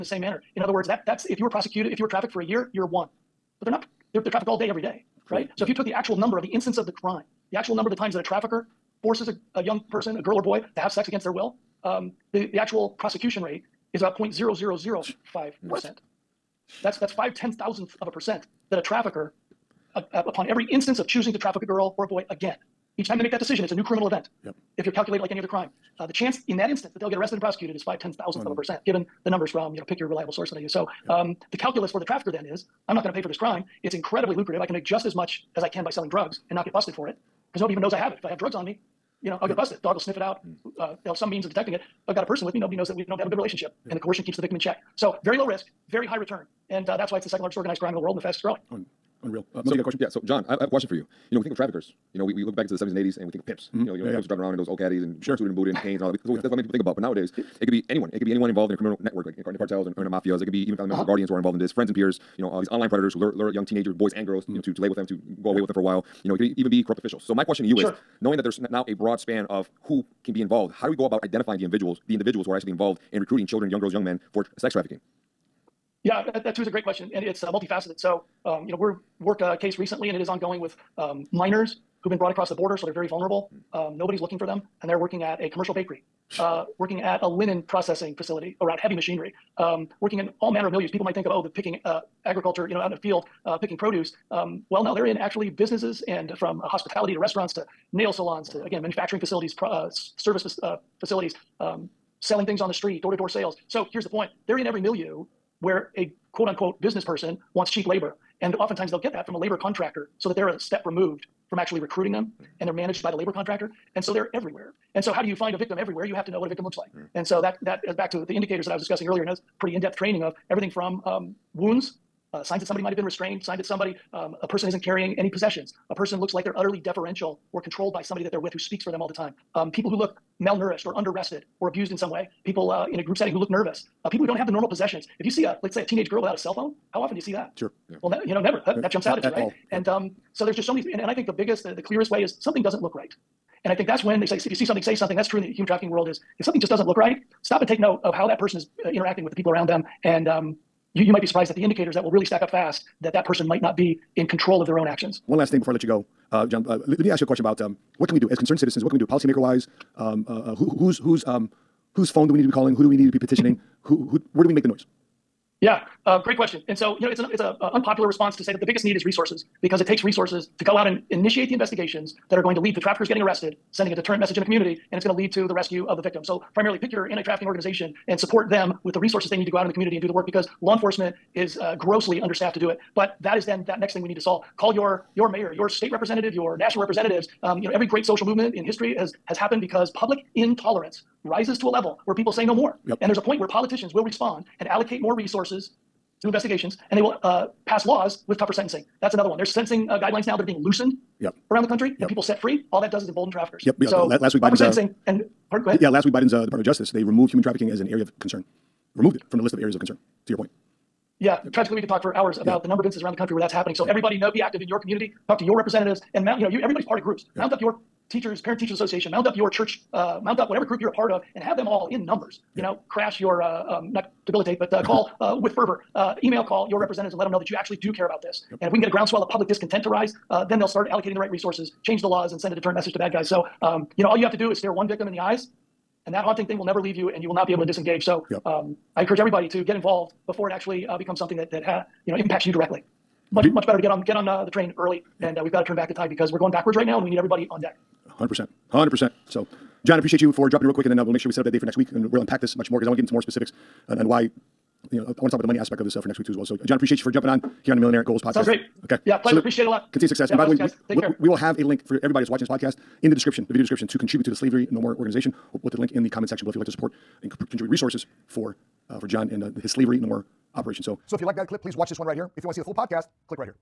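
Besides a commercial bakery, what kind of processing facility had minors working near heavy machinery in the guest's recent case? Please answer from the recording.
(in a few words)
Linen processing facility.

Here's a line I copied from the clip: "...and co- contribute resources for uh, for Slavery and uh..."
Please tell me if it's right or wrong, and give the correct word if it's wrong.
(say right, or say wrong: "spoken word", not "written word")
wrong: "John", not "Slavery".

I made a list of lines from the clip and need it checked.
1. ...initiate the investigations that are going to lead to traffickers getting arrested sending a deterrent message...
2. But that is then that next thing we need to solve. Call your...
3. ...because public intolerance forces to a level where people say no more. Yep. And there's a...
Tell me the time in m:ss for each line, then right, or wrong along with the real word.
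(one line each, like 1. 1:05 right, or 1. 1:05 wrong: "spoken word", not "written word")
1. 2:51 right
2. 3:02 right
3. 3:09 wrong: "rises", not "forces".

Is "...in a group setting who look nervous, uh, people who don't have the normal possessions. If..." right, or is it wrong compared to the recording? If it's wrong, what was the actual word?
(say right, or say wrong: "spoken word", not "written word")
right.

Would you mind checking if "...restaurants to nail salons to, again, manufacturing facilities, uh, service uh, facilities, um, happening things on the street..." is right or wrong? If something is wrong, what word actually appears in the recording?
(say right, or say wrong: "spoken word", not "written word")
wrong: "selling", not "happening".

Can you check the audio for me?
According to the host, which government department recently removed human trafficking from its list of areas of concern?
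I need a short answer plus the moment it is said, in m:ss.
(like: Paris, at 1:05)
Department of Justice, at 3:26.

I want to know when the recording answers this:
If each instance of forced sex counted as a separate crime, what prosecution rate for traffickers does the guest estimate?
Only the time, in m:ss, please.
0:14.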